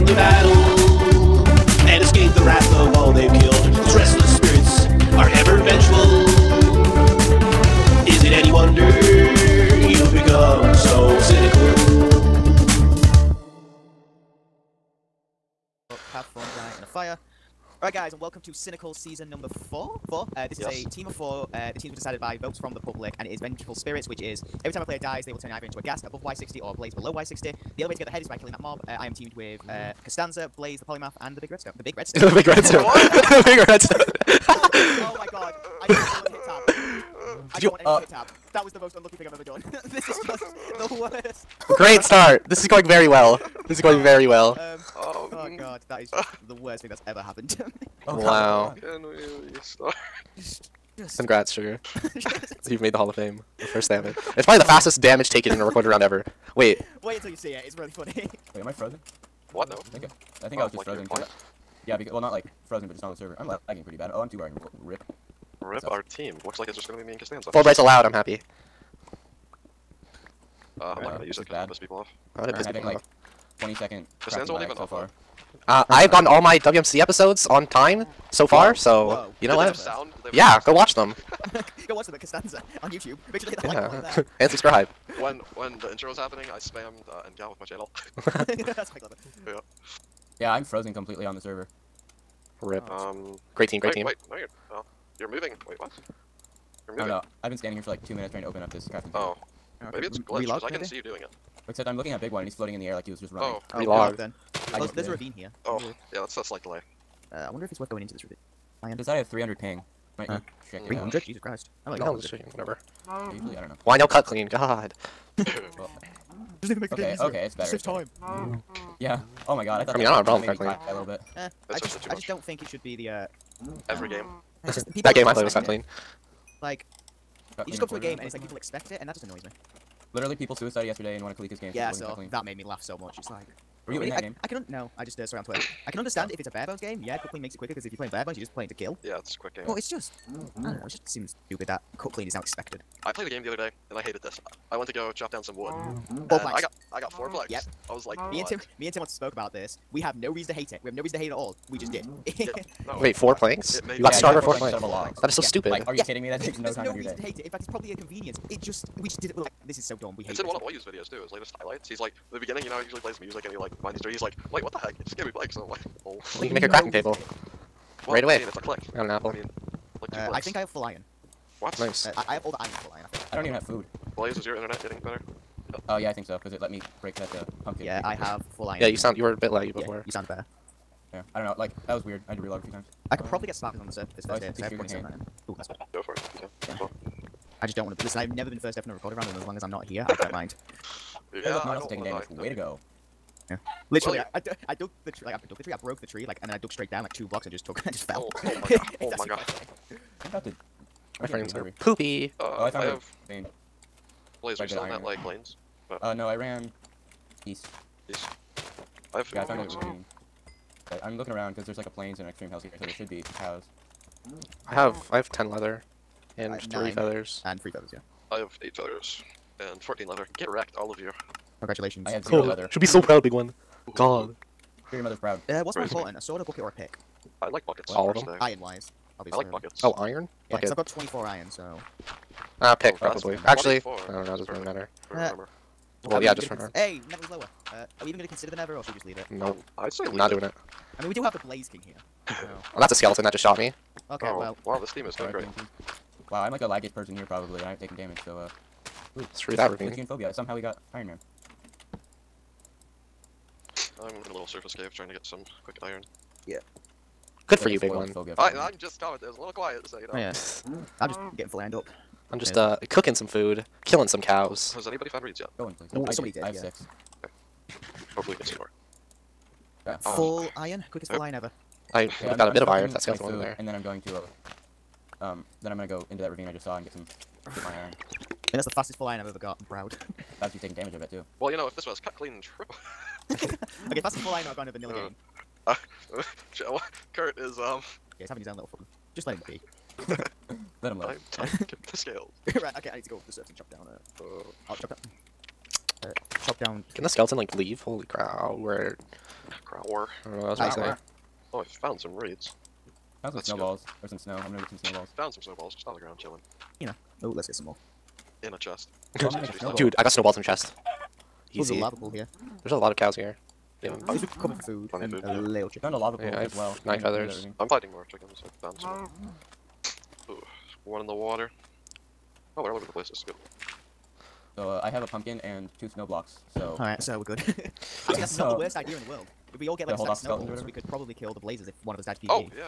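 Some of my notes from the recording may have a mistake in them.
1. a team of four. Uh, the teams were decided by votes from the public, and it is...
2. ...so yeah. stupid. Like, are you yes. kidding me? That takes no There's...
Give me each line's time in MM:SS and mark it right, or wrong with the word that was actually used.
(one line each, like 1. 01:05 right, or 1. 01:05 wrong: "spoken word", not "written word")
1. 00:20 right
2. 02:35 right.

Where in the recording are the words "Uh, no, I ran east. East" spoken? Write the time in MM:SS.
03:26.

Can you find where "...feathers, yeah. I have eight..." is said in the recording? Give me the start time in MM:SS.
03:37.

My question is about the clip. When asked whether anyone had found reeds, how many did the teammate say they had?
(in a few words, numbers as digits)
6.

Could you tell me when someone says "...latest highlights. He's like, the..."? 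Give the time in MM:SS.
02:41.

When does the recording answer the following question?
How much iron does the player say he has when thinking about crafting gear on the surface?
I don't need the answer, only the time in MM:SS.
03:04.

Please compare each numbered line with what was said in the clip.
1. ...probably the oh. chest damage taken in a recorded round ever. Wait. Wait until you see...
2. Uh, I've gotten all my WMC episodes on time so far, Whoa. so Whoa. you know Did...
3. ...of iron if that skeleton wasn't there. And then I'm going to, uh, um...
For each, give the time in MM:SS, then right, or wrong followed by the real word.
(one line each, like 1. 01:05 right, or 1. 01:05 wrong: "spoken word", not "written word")
1. 00:54 wrong: "fastest", not "chest"
2. 01:15 right
3. 04:32 right.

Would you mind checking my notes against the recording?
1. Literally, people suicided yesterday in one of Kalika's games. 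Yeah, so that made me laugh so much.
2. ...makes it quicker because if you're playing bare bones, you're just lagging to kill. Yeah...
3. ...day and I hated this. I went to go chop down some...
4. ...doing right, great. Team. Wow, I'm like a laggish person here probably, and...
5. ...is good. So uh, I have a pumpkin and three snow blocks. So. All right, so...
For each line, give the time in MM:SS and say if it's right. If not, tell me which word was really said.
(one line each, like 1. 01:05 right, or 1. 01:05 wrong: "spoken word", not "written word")
1. 02:10 right
2. 02:17 wrong: "playing", not "lagging"
3. 02:23 right
4. 04:05 right
5. 05:23 wrong: "two", not "three".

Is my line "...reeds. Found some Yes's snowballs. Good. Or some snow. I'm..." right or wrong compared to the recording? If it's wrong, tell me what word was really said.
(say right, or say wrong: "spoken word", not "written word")
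wrong: "That", not "Yes".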